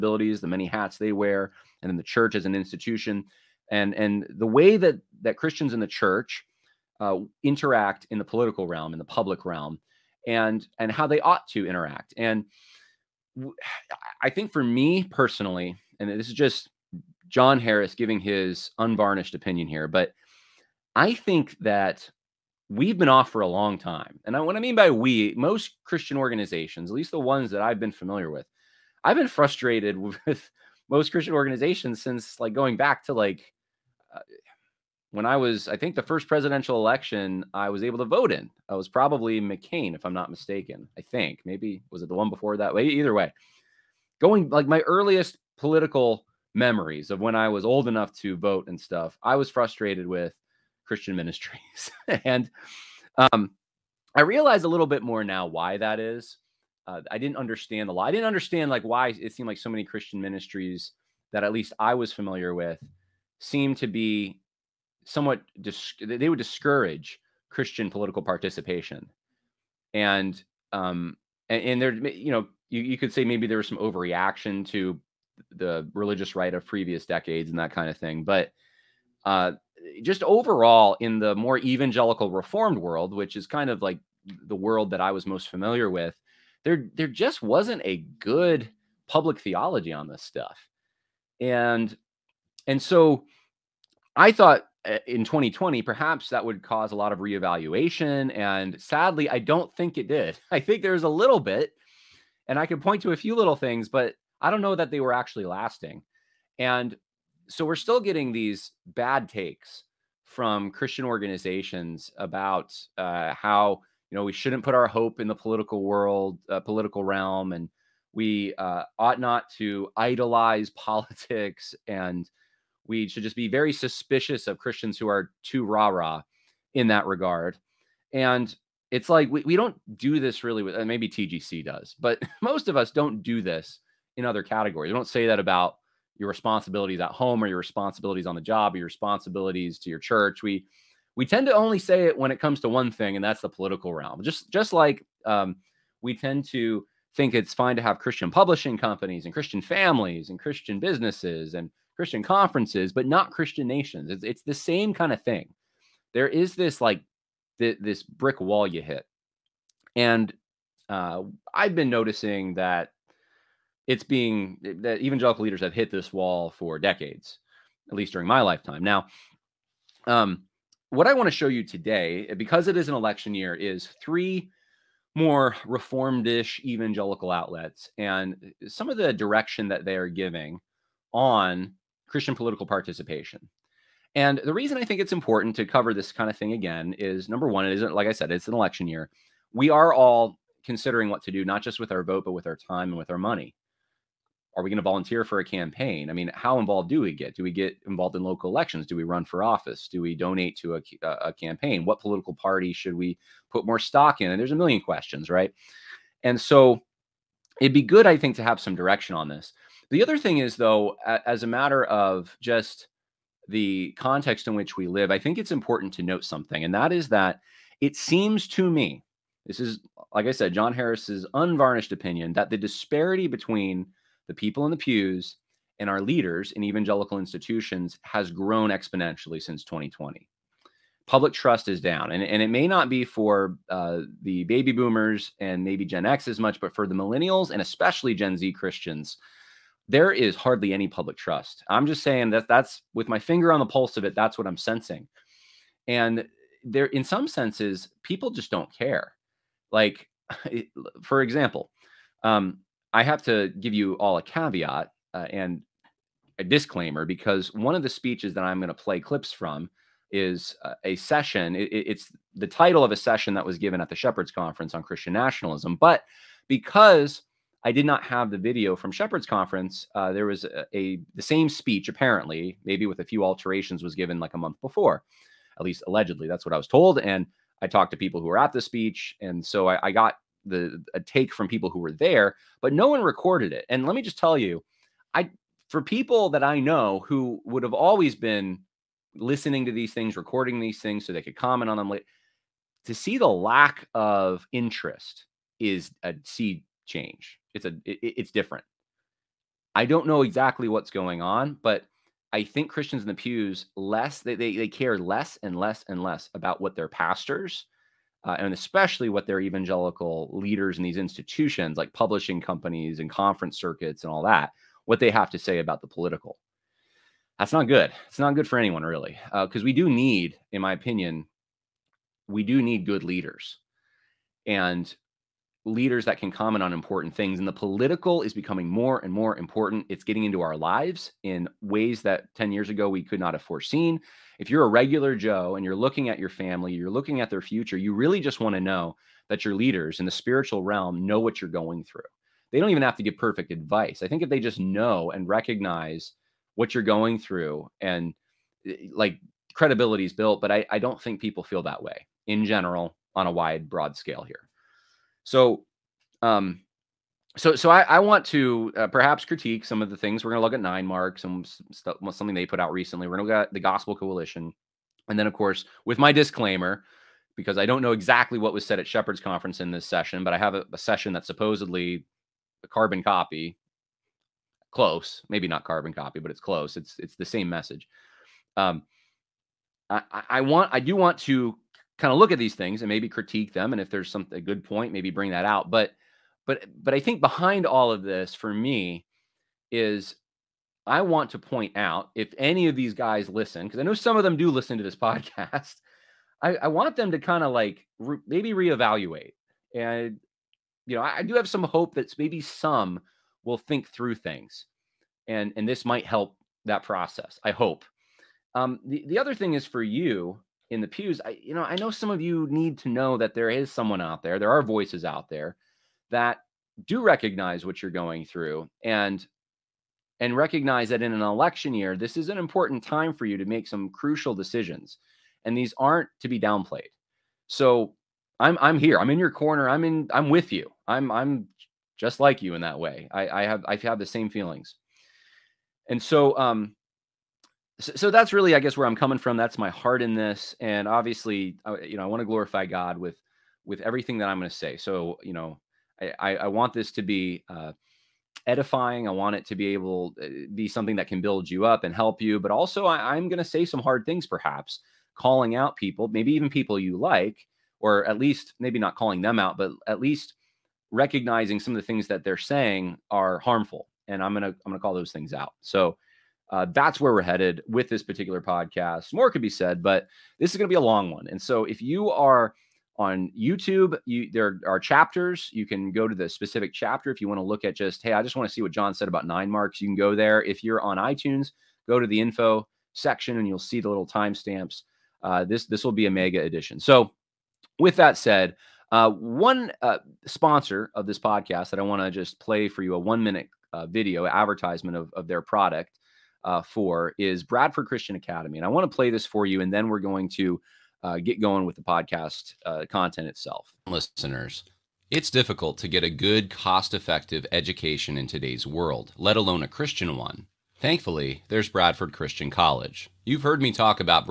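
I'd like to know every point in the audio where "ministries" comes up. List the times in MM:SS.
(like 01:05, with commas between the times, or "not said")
00:51, 01:00.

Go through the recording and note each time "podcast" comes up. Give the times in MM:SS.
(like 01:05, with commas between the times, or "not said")
06:34, 07:48, 08:11, 08:21.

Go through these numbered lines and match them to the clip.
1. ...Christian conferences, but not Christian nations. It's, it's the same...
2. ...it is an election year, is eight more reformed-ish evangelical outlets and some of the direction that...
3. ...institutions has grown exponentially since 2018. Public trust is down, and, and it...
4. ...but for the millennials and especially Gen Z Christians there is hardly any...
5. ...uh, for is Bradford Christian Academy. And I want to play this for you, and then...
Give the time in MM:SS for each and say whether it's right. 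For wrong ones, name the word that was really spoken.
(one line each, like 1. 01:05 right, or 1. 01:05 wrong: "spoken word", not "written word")
1. 02:31 right
2. 02:52 wrong: "three", not "eight"
3. 03:47 wrong: "2020", not "2018"
4. 03:56 right
5. 08:16 right.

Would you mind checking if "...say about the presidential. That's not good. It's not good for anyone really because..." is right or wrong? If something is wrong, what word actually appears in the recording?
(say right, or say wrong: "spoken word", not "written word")
wrong: "political", not "presidential".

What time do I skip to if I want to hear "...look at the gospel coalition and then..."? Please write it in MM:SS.
06:03.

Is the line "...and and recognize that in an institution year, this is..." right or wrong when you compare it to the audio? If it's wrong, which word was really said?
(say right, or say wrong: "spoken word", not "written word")
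wrong: "election", not "institution".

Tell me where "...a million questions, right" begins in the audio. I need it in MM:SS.
03:24.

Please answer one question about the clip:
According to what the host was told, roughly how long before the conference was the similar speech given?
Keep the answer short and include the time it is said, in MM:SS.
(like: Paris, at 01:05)
a month, at 04:34.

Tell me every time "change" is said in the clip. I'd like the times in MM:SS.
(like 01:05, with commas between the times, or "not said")
04:56.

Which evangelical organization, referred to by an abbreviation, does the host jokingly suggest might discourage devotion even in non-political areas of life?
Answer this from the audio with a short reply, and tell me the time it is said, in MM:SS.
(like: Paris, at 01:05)
TGC, at 02:11.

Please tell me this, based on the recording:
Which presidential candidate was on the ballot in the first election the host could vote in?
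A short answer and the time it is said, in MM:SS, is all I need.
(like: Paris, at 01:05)
McCain, at 00:39.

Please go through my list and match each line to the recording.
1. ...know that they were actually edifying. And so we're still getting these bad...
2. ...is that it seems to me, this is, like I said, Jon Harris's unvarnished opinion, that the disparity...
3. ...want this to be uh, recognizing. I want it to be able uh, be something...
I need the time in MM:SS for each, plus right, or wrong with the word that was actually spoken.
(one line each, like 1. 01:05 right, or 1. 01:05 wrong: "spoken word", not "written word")
1. 01:44 wrong: "lasting", not "edifying"
2. 03:36 right
3. 07:26 wrong: "edifying", not "recognizing".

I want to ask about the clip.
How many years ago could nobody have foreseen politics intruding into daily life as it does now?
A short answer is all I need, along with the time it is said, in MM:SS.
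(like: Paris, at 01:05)
10 years, at 05:32.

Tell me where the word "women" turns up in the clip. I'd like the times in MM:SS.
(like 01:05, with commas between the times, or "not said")
not said.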